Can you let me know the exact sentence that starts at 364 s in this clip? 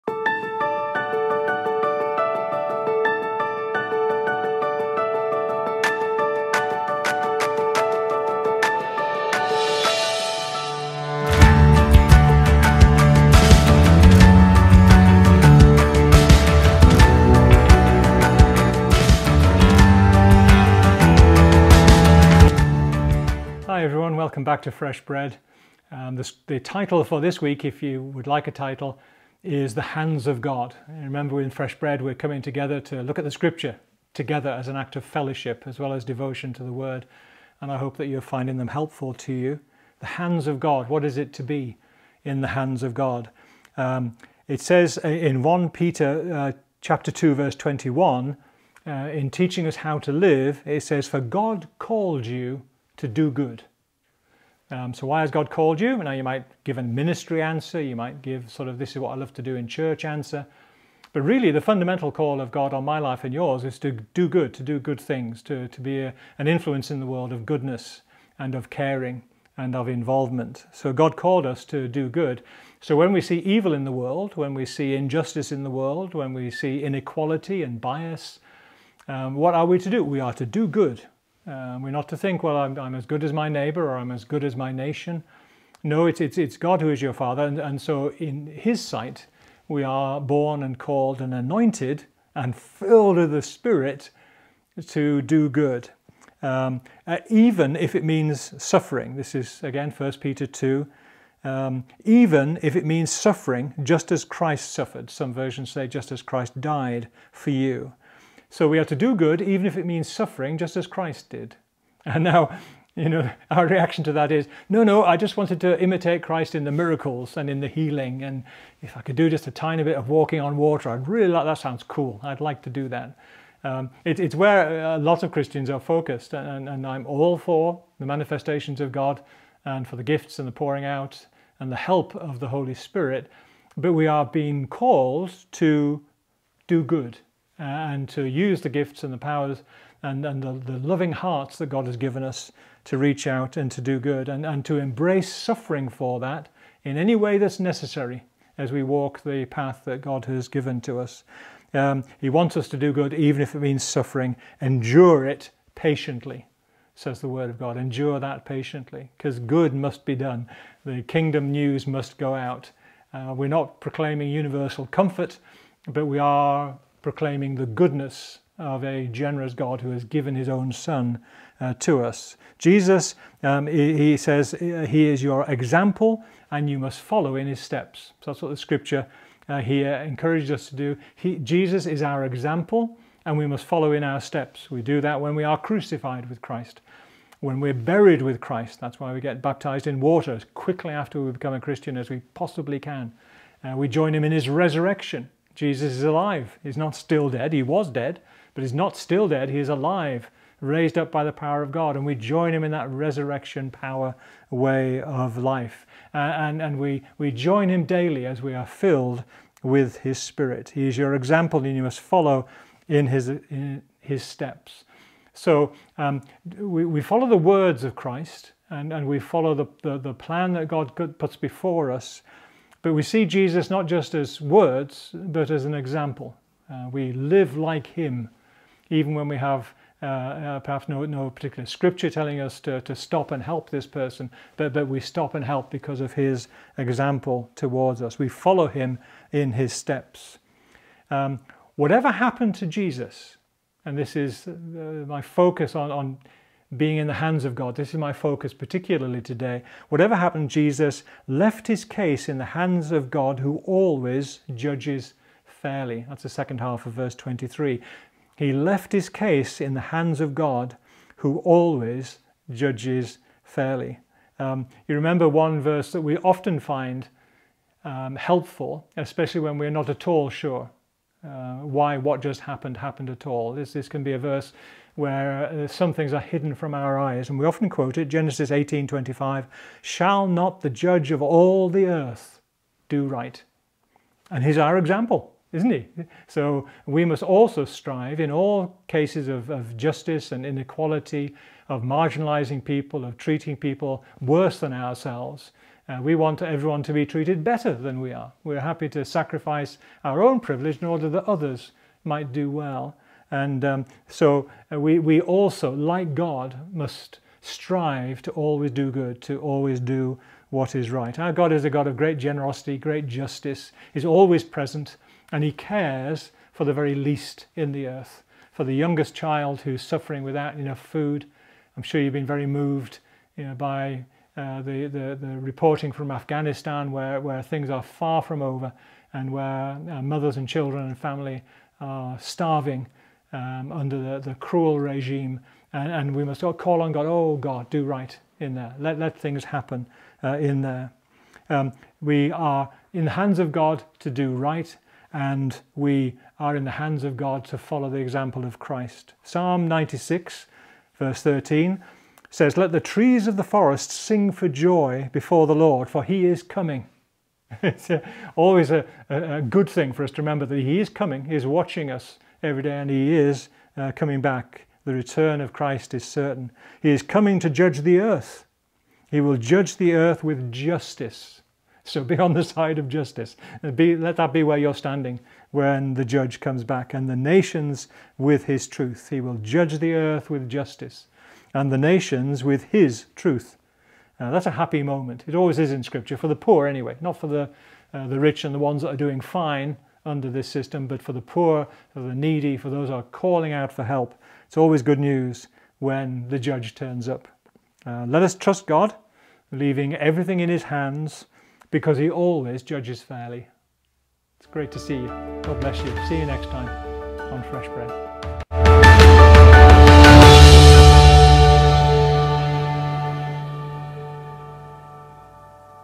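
The return of Christ is certain.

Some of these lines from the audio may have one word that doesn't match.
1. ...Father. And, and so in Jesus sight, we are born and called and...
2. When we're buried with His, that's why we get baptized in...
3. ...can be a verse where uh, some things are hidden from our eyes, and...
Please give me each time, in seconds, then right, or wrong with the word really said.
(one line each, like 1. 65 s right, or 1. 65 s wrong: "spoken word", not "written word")
1. 87 s wrong: "His", not "Jesus"
2. 187 s wrong: "Christ", not "His"
3. 273 s right.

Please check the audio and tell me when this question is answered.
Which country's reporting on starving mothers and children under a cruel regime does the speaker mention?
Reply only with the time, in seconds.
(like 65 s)
326 s.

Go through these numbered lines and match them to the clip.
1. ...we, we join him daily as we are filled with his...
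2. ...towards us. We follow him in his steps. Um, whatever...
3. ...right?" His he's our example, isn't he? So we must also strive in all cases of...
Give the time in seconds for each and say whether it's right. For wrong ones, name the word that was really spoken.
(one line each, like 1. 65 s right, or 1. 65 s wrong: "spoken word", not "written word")
1. 206 s right
2. 237 s right
3. 283 s wrong: "And", not "His".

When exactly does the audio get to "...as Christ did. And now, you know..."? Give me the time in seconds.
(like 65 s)
110 s.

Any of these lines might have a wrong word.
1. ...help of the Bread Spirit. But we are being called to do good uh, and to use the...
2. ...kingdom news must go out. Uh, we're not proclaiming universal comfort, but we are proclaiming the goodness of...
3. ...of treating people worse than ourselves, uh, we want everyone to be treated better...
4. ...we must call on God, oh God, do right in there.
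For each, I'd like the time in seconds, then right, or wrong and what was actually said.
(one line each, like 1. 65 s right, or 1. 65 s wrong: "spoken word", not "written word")
1. 131 s wrong: "Holy", not "Bread"
2. 161 s right
3. 293 s right
4. 336 s right.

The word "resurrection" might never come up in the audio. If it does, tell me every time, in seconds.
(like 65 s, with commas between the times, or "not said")
194 s, 202 s.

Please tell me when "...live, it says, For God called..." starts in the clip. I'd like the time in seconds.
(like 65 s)
50 s.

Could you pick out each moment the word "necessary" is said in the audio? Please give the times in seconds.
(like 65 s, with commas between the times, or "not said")
147 s.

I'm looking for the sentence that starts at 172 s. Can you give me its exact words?
Jesus, um, he, he, says, uh, he is your example and you must follow in his steps.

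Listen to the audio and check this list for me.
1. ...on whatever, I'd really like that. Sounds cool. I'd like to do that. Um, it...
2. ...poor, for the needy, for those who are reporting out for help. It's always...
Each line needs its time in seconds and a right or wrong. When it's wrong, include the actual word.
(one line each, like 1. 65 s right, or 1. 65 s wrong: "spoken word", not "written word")
1. 120 s wrong: "water", not "whatever"
2. 391 s wrong: "calling", not "reporting".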